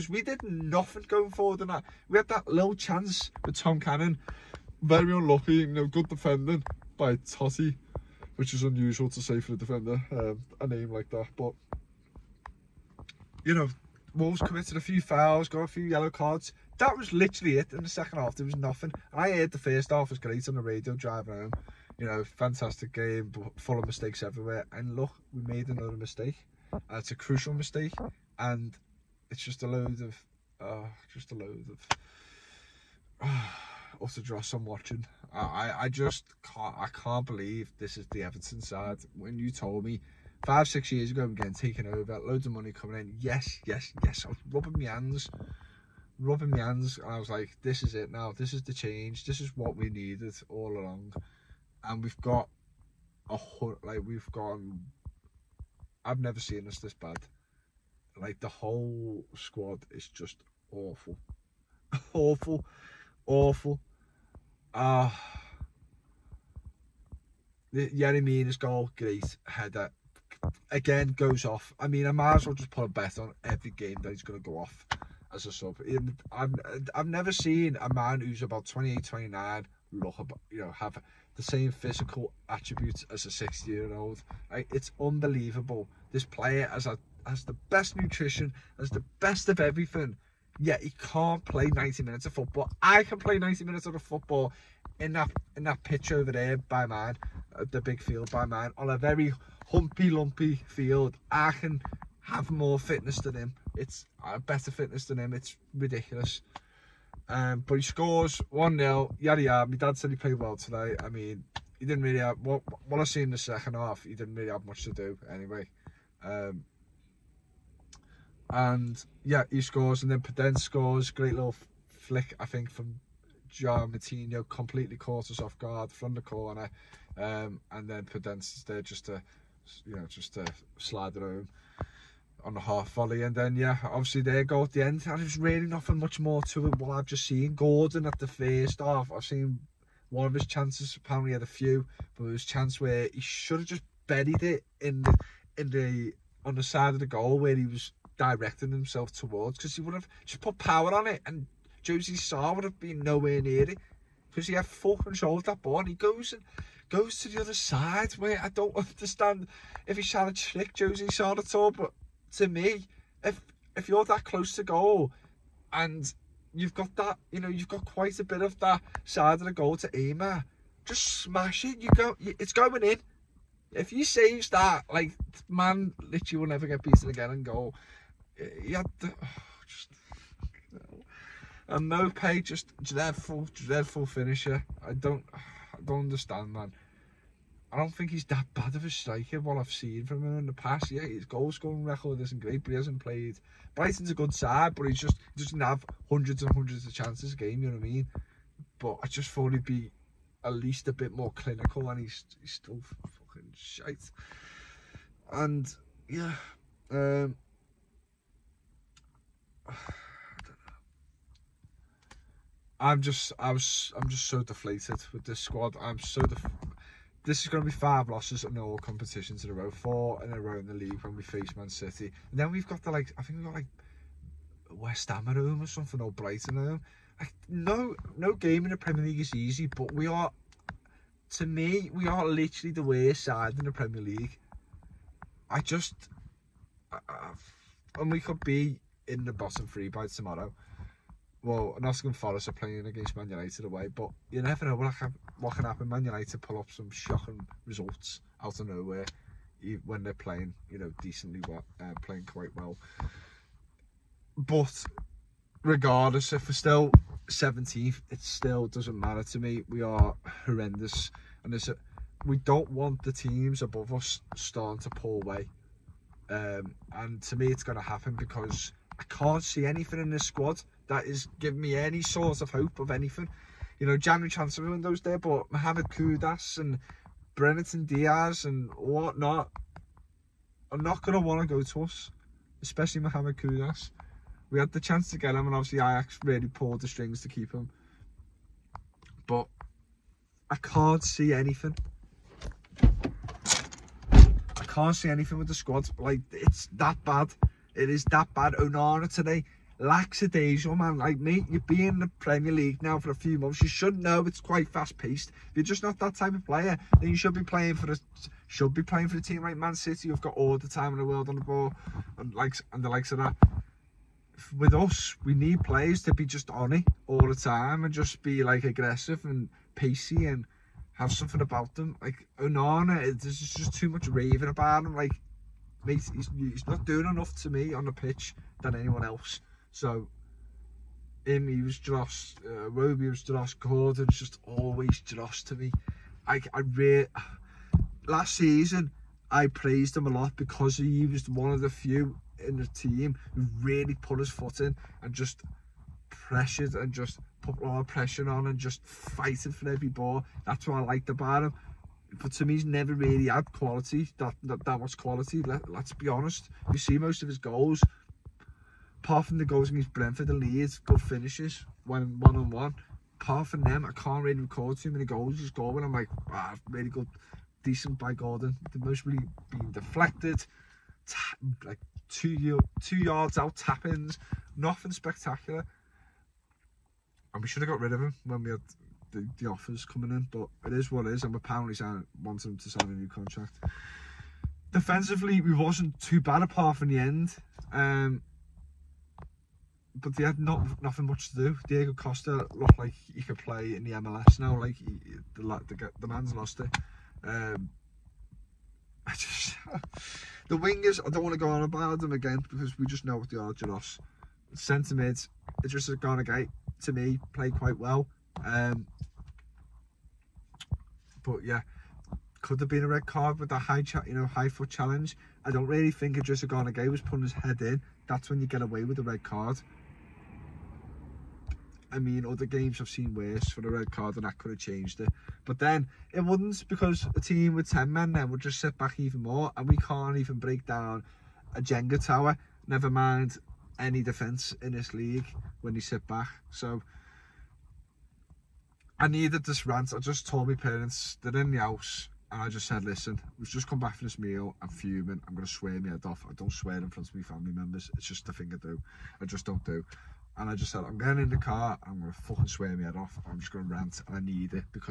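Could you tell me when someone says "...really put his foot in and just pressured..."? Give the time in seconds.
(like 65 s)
343 s.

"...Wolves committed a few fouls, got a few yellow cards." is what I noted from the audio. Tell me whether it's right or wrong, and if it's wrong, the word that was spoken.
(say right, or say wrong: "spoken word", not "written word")
right.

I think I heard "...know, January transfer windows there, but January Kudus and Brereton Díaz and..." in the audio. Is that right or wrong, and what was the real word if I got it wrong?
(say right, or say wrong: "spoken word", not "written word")
wrong: "Mohammed", not "January".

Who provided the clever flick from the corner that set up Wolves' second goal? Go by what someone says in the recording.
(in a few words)
Joao Moutinho.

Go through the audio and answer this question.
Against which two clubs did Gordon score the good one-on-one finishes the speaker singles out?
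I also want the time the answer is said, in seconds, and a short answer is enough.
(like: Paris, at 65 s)
Brentford and Leeds, at 359 s.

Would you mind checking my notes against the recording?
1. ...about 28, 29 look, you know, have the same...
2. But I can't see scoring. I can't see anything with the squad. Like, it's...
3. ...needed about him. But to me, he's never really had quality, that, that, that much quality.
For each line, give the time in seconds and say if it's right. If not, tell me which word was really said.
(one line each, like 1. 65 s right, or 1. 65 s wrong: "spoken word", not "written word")
1. 78 s right
2. 289 s wrong: "anything", not "scoring"
3. 350 s wrong: "liked", not "needed".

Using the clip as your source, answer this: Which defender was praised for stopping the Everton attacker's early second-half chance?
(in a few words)
Toti.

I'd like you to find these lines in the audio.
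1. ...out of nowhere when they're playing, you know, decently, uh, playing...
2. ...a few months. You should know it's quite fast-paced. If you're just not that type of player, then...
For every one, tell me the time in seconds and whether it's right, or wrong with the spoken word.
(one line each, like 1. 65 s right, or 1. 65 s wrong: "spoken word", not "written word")
1. 248 s right
2. 303 s right.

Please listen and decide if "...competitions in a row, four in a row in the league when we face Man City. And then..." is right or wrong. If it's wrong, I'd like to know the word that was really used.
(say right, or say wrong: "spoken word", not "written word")
right.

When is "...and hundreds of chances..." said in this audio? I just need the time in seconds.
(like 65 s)
196 s.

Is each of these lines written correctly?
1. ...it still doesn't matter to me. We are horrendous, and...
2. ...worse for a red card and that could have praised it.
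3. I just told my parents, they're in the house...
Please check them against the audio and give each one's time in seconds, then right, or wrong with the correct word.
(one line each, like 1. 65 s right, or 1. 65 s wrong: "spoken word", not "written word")
1. 258 s right
2. 423 s wrong: "changed", not "praised"
3. 439 s right.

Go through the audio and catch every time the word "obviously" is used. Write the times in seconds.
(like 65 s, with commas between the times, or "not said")
133 s, 285 s.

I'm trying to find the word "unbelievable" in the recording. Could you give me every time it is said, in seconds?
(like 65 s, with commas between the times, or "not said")
84 s.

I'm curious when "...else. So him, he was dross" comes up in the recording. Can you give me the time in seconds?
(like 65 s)
329 s.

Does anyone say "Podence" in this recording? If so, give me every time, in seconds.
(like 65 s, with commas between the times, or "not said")
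120 s, 128 s.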